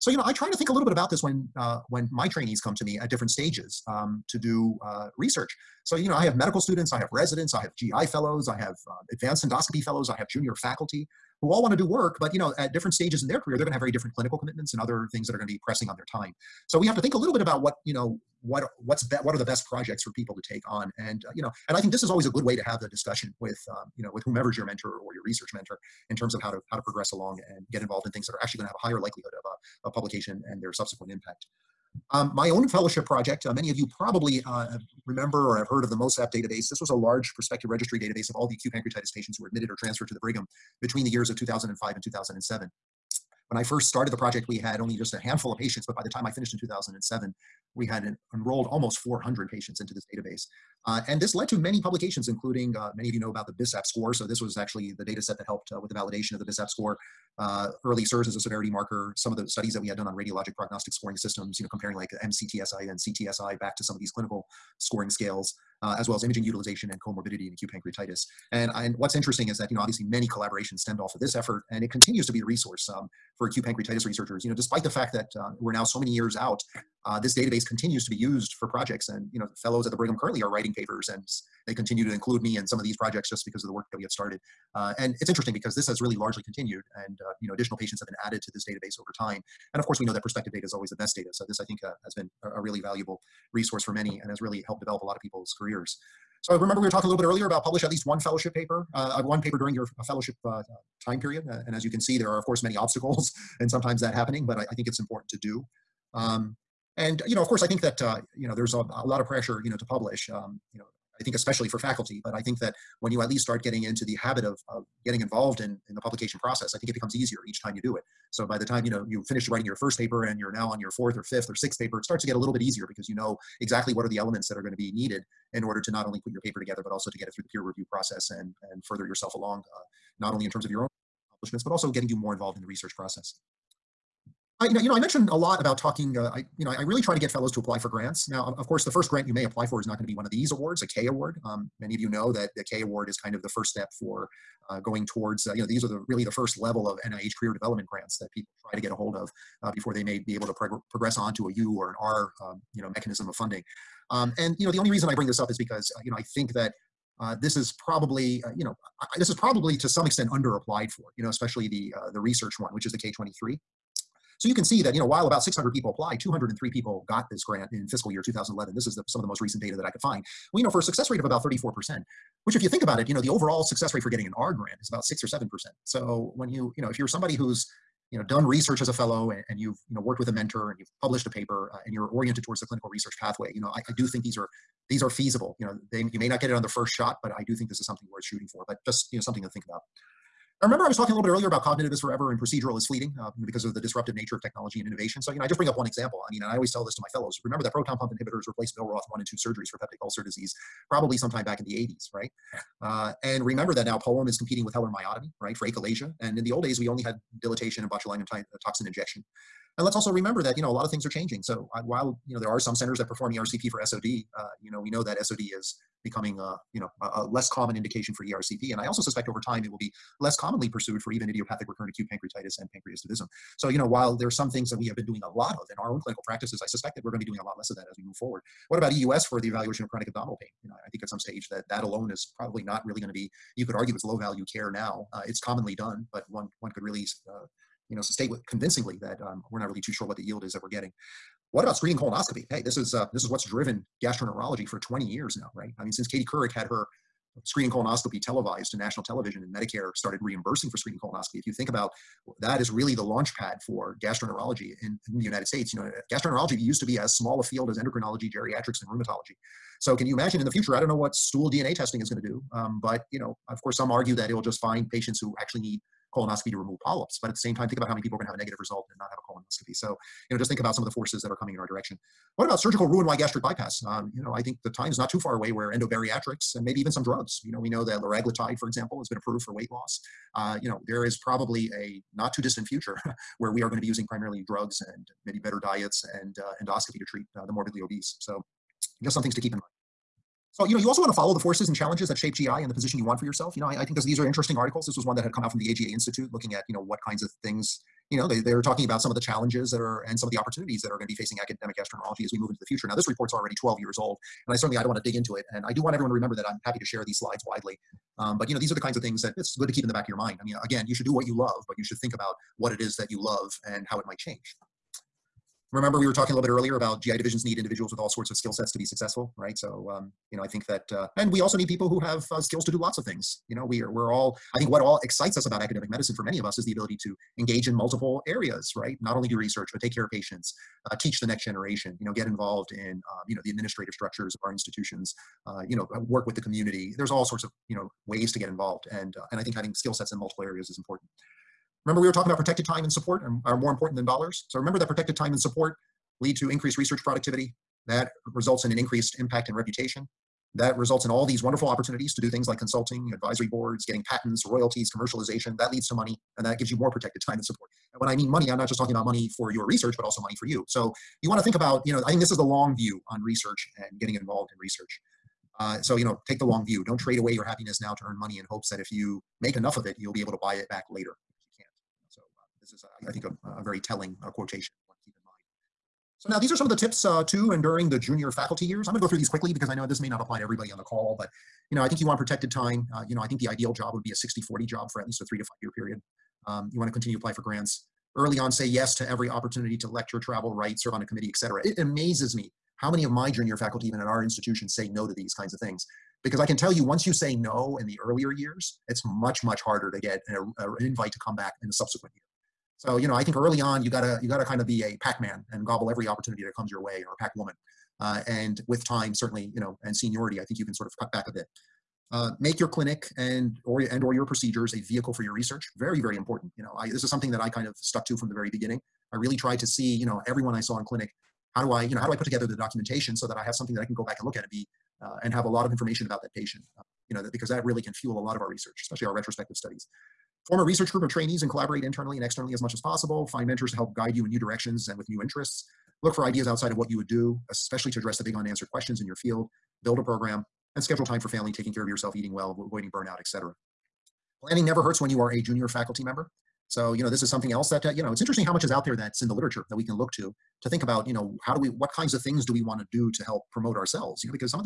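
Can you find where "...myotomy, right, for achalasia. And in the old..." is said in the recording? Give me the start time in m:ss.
3:24.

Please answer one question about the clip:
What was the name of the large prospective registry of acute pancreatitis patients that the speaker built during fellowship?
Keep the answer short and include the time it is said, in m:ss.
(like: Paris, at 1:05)
MOSAP, at 0:35.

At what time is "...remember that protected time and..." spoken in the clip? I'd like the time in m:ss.
5:44.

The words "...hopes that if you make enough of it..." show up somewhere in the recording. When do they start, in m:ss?
6:08.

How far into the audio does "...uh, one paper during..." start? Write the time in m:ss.
1:39.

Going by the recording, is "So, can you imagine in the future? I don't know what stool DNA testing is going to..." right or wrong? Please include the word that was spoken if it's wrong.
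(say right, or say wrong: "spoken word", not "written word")
right.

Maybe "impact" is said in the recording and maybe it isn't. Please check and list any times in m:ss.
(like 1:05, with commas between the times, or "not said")
0:31, 5:49.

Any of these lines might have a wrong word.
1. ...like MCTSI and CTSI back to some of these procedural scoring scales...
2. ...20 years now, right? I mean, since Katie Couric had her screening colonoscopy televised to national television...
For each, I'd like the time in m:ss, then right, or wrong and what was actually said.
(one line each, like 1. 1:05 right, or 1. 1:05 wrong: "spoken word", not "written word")
1. 1:01 wrong: "clinical", not "procedural"
2. 4:04 right.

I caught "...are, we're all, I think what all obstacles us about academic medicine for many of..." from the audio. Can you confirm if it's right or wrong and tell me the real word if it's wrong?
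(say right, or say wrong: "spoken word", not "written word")
wrong: "excites", not "obstacles".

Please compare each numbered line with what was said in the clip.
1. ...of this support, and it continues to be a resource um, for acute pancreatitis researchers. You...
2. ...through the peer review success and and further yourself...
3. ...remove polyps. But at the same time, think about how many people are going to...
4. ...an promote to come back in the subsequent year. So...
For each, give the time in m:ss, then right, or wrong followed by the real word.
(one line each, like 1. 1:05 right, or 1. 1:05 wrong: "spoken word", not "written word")
1. 1:11 wrong: "effort", not "support"
2. 2:07 wrong: "process", not "success"
3. 4:26 right
4. 6:40 wrong: "invite", not "promote".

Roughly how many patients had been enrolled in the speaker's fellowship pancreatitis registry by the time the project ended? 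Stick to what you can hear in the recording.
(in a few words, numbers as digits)
almost 400.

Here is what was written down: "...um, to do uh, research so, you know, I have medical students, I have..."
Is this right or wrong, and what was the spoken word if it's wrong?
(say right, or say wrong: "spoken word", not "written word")
right.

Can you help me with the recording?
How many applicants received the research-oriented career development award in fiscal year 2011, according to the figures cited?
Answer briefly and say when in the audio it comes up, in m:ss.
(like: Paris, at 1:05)
203, at 2:46.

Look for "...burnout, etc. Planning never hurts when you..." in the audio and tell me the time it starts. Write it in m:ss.
7:22.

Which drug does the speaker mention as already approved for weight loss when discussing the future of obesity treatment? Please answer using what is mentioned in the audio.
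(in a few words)
liraglutide.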